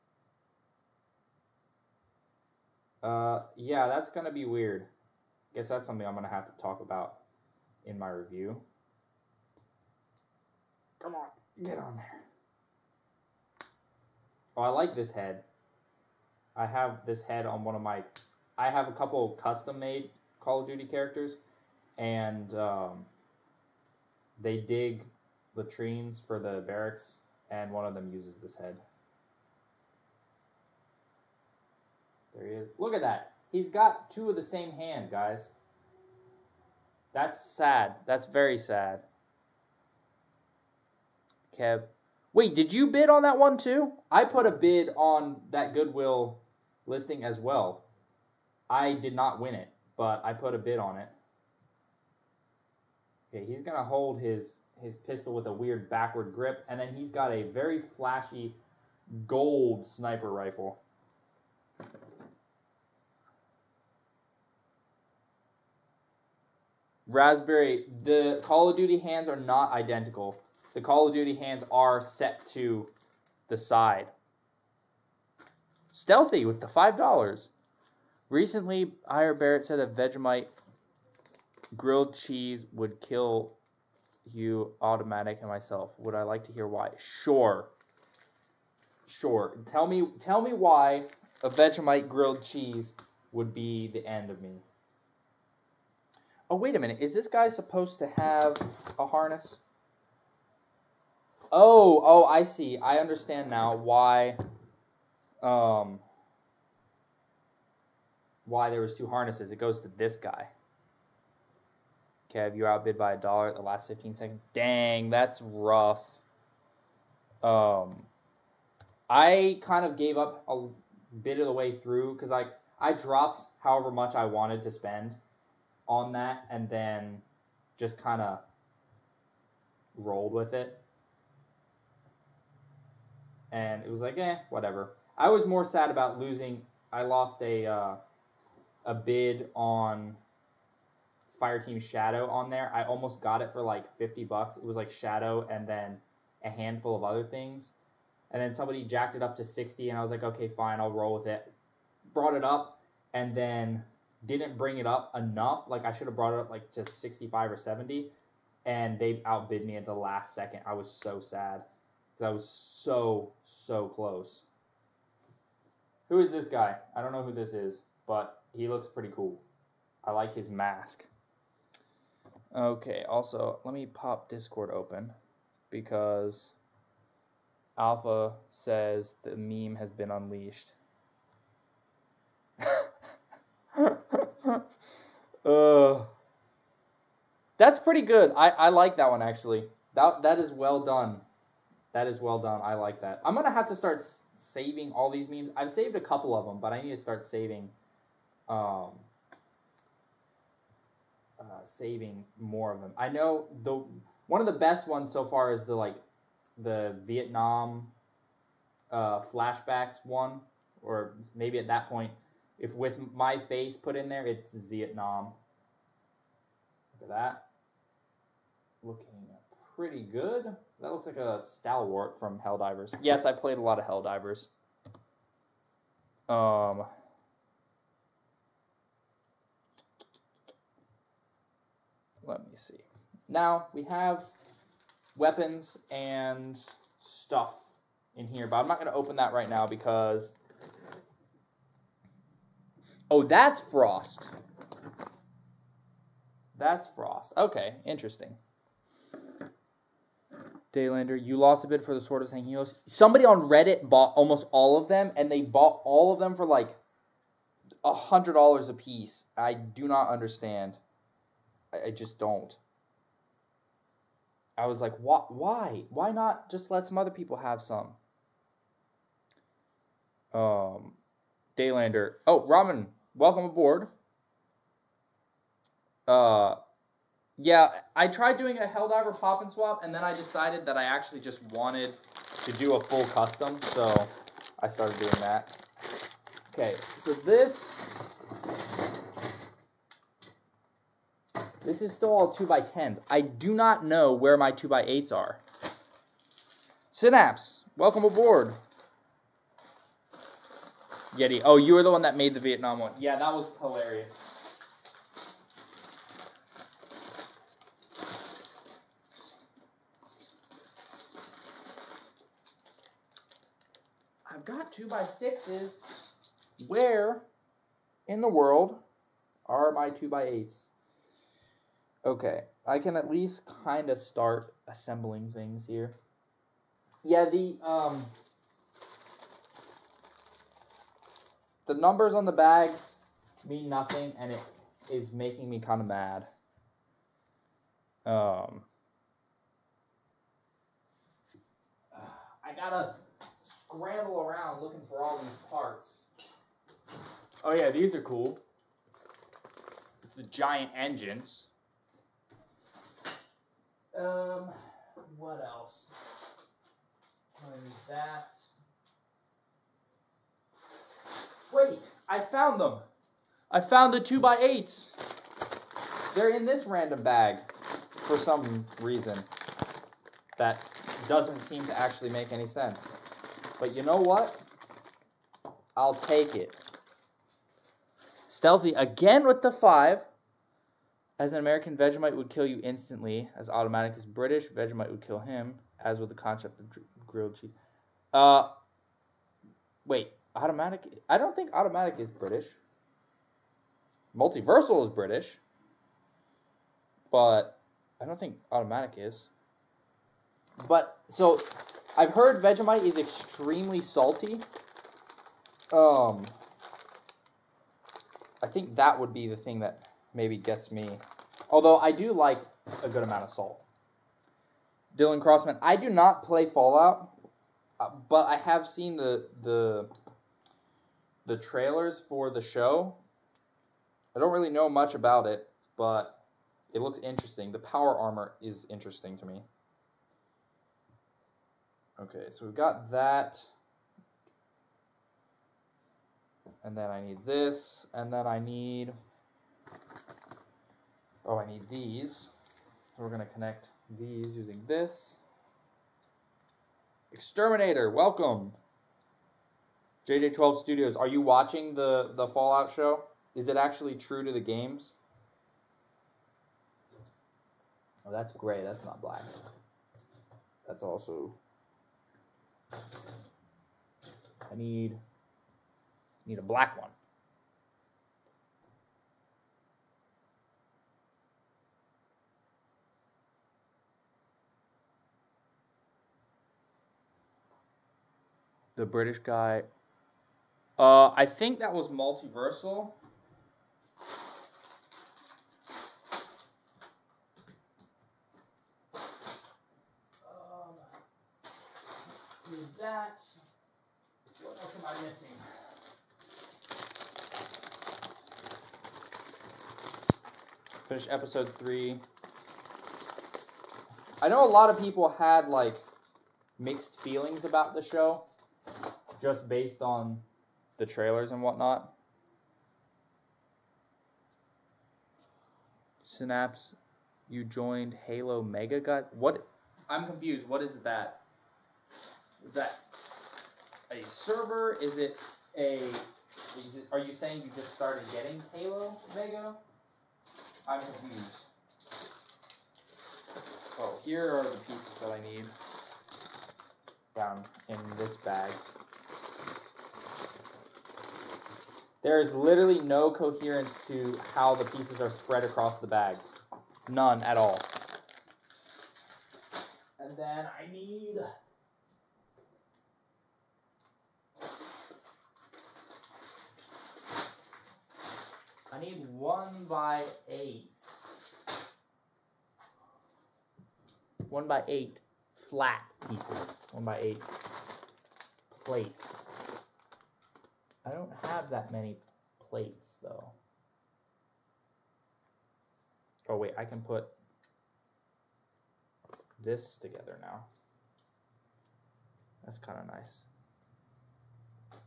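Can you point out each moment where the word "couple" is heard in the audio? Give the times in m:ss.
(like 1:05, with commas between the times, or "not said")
0:18, 3:16.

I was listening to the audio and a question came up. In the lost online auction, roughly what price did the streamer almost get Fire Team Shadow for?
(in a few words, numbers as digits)
$50.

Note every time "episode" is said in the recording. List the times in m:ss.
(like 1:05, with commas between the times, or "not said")
8:21.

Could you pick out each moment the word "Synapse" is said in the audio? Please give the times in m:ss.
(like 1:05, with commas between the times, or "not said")
4:56, 8:36.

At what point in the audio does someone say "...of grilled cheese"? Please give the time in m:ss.
6:26.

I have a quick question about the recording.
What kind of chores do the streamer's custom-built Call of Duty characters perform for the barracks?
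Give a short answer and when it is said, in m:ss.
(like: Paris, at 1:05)
Dig latrines, at 0:24.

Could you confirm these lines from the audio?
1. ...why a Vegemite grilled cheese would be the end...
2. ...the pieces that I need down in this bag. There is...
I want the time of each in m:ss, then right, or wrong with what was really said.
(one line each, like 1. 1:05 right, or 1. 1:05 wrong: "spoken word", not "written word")
1. 1:30 right
2. 8:54 right.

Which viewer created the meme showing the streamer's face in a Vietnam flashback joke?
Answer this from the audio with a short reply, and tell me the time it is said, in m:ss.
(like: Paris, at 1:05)
Yeti, at 5:01.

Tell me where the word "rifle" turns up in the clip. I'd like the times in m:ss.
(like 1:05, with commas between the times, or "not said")
1:00.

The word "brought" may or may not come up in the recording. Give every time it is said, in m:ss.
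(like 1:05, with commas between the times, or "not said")
2:32, 2:36.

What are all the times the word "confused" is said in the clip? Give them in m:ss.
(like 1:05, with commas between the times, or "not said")
8:40, 8:50.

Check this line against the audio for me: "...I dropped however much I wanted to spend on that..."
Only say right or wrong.
right.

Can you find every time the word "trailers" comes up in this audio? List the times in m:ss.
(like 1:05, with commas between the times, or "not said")
7:01, 8:30.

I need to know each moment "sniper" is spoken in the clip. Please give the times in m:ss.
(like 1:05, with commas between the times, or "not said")
0:59.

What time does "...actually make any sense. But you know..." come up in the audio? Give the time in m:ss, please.
6:11.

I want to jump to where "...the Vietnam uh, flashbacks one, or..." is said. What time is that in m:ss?
3:26.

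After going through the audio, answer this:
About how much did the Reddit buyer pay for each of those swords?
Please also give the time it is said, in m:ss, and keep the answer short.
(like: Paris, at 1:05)
$100, at 4:17.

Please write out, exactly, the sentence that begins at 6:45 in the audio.
Um, I think that would be the thing that maybe gets me.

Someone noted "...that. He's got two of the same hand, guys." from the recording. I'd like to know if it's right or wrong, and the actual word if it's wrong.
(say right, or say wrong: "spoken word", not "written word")
right.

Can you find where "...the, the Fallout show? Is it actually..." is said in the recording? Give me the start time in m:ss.
7:31.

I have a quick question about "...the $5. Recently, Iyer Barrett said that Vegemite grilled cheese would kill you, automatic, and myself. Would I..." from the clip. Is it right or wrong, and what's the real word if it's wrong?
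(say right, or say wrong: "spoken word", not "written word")
right.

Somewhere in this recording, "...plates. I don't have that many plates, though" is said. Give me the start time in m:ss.
9:28.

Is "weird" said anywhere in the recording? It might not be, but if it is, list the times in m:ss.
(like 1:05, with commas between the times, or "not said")
0:04, 0:55.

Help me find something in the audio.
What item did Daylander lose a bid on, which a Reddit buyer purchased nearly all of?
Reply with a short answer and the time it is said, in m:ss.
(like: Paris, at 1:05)
Sword of Sanghelios, at 4:11.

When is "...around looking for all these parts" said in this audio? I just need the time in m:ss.
5:44.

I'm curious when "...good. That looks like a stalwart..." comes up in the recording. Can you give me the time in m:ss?
3:40.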